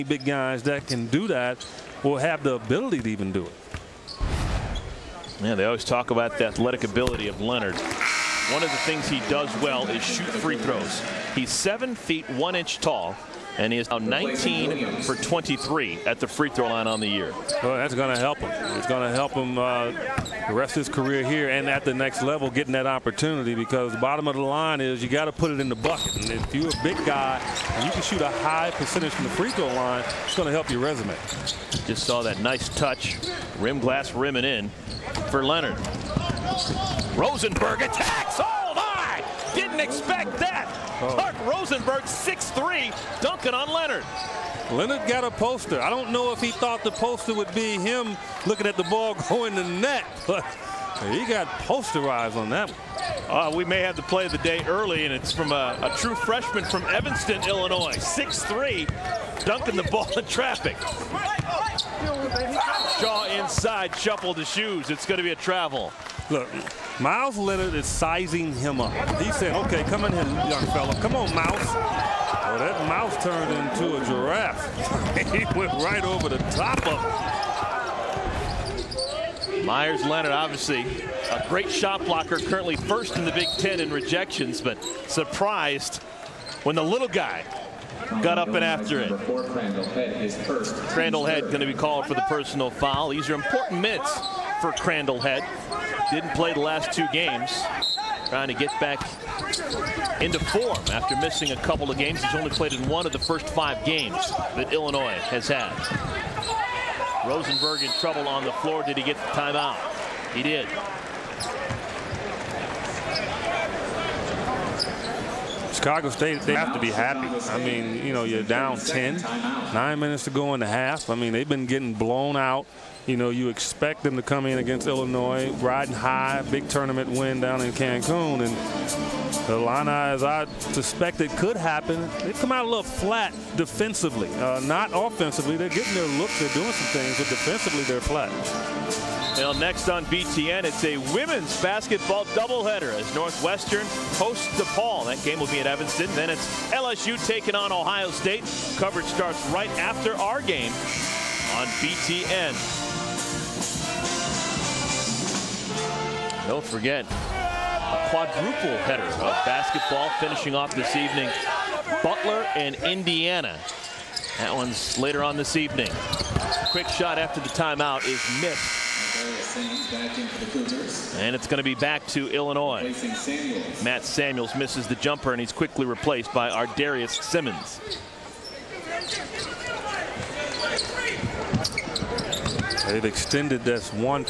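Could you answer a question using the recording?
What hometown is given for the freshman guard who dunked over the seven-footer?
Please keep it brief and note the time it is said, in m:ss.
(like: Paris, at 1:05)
Evanston, Illinois, at 0:56.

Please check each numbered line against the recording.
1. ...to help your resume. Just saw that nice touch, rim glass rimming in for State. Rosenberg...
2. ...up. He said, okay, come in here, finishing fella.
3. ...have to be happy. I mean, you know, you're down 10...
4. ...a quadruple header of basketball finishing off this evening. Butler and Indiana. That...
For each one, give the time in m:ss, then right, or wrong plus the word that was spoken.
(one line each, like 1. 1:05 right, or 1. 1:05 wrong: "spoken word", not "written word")
1. 0:30 wrong: "Leonard", not "State"
2. 1:08 wrong: "young", not "finishing"
3. 1:56 right
4. 2:37 right.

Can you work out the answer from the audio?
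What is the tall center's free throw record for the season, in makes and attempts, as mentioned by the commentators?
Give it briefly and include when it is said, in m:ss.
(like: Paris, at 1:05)
19 for 23, at 0:13.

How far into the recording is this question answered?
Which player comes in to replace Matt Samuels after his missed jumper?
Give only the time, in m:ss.
2:56.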